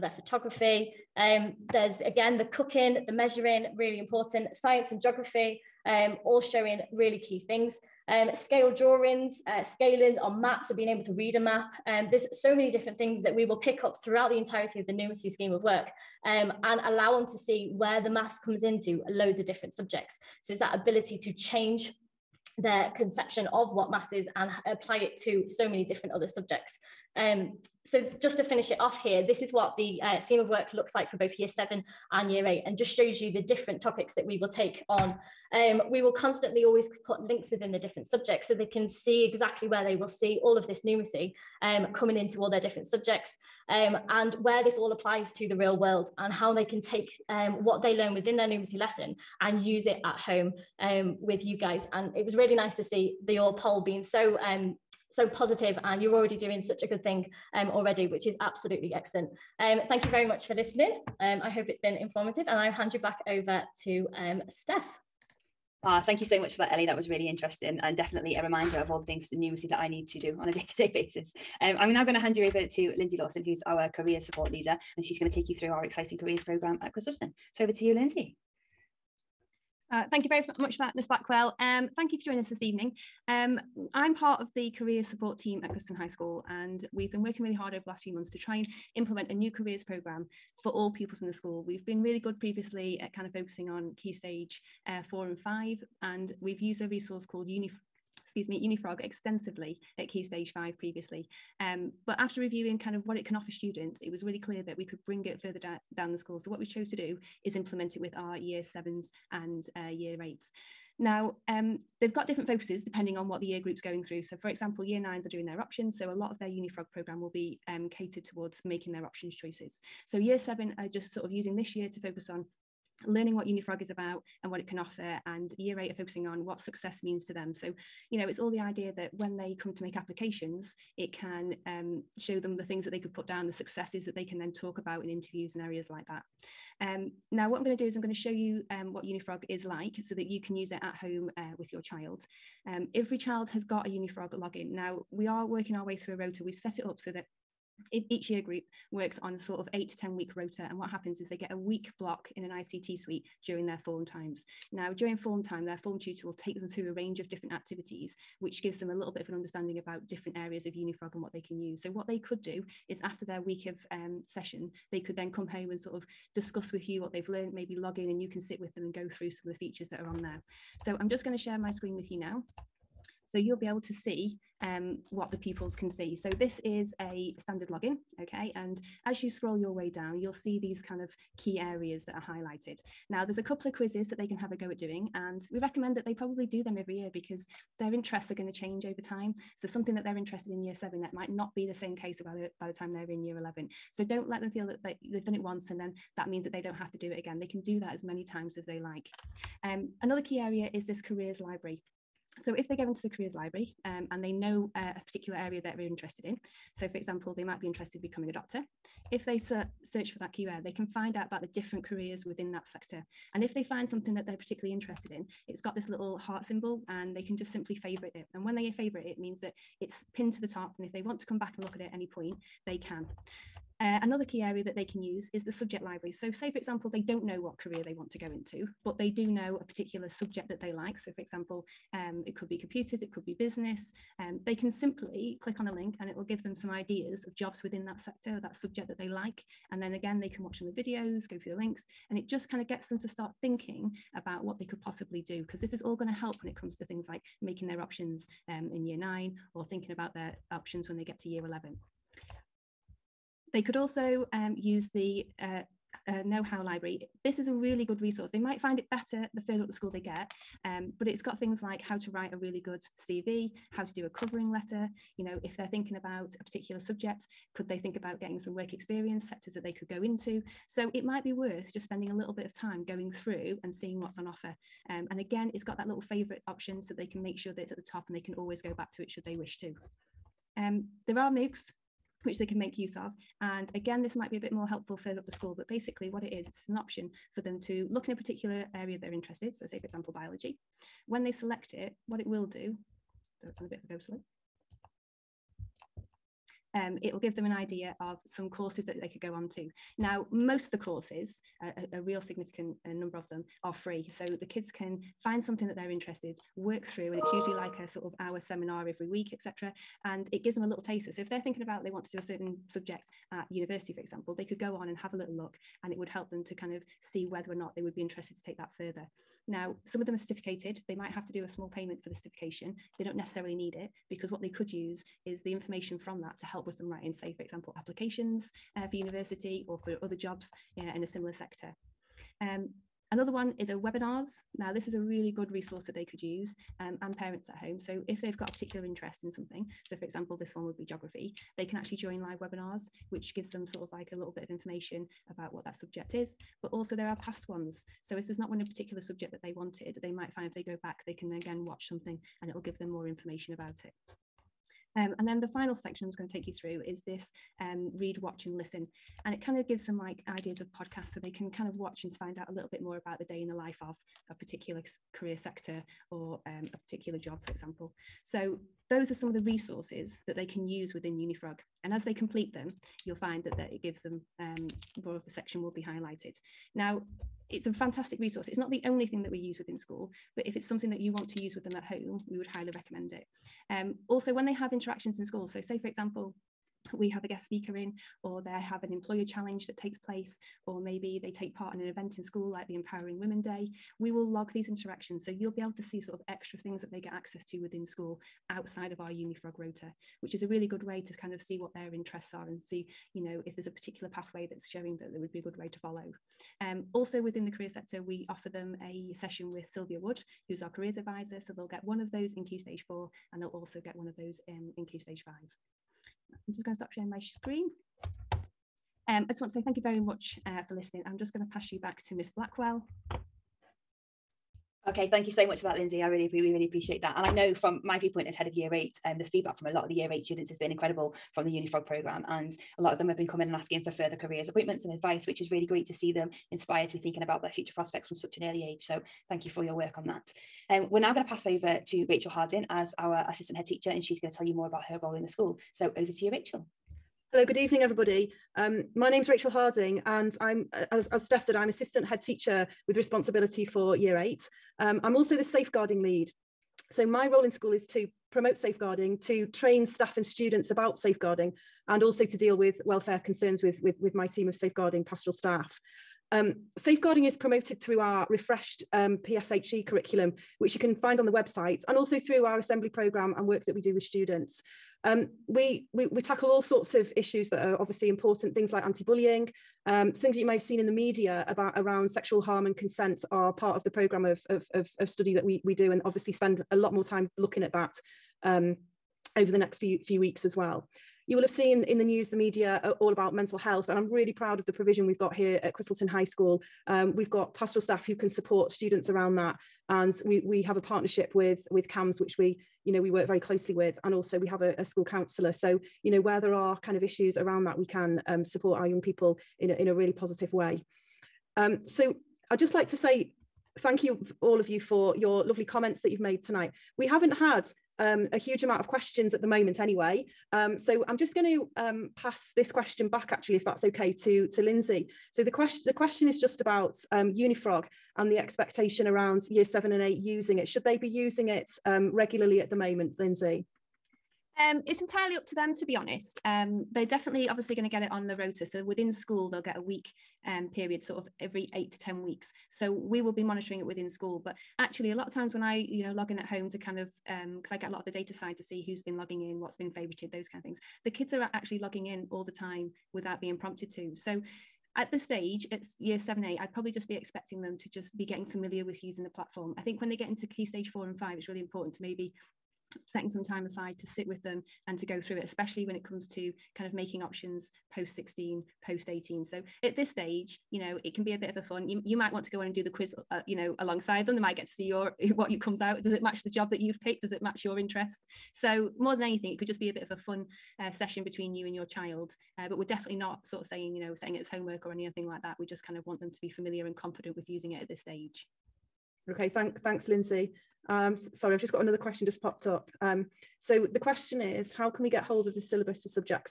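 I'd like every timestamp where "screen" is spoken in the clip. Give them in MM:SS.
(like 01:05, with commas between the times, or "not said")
02:51, 06:57.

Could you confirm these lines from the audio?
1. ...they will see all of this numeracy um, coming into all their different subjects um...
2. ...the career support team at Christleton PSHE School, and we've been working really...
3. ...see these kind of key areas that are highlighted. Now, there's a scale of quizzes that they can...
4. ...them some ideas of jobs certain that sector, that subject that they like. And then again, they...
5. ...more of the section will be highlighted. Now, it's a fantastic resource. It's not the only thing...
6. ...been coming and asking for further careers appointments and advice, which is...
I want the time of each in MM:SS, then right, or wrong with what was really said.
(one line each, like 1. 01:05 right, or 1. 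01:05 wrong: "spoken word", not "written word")
1. 00:39 right
2. 01:24 wrong: "High", not "PSHE"
3. 03:00 wrong: "couple", not "scale"
4. 03:56 wrong: "within", not "certain"
5. 06:15 right
6. 07:13 right.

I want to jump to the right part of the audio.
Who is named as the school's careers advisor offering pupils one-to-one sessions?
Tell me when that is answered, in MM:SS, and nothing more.
06:49.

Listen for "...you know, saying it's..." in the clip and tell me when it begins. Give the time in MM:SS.
09:43.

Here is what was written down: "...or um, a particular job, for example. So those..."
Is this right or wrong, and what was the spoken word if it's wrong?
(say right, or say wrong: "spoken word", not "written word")
right.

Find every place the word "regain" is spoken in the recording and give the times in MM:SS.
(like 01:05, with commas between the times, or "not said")
not said.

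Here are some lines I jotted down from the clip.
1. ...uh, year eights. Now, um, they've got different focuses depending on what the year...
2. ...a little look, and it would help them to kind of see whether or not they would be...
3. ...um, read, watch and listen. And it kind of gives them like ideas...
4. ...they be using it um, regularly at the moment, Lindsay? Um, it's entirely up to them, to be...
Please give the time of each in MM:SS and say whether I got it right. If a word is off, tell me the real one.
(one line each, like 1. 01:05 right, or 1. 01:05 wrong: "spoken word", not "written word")
1. 01:49 right
2. 05:15 right
3. 05:57 right
4. 08:50 right.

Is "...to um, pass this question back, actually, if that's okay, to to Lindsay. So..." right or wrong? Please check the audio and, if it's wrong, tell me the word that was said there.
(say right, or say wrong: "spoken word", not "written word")
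right.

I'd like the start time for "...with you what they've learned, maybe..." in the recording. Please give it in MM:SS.
02:46.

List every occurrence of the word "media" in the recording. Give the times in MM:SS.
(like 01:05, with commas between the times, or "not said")
08:00, 08:12.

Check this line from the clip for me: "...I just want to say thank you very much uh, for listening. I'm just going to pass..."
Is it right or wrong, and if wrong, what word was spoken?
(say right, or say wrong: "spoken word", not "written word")
right.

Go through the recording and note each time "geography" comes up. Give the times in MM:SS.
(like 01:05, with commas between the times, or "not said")
00:05, 05:40.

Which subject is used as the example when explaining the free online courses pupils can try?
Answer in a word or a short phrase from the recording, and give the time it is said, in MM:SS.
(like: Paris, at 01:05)
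biology, at 04:50.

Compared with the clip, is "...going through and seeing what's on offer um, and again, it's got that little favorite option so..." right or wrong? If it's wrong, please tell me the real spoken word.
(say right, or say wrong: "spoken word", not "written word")
right.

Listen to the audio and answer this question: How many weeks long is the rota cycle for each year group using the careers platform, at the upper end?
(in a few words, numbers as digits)
10.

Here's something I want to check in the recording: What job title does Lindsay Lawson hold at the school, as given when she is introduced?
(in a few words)
career support leader.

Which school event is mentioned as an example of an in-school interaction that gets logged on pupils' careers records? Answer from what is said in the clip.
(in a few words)
Empowering Women Day.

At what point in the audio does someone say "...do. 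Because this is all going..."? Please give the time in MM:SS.
04:05.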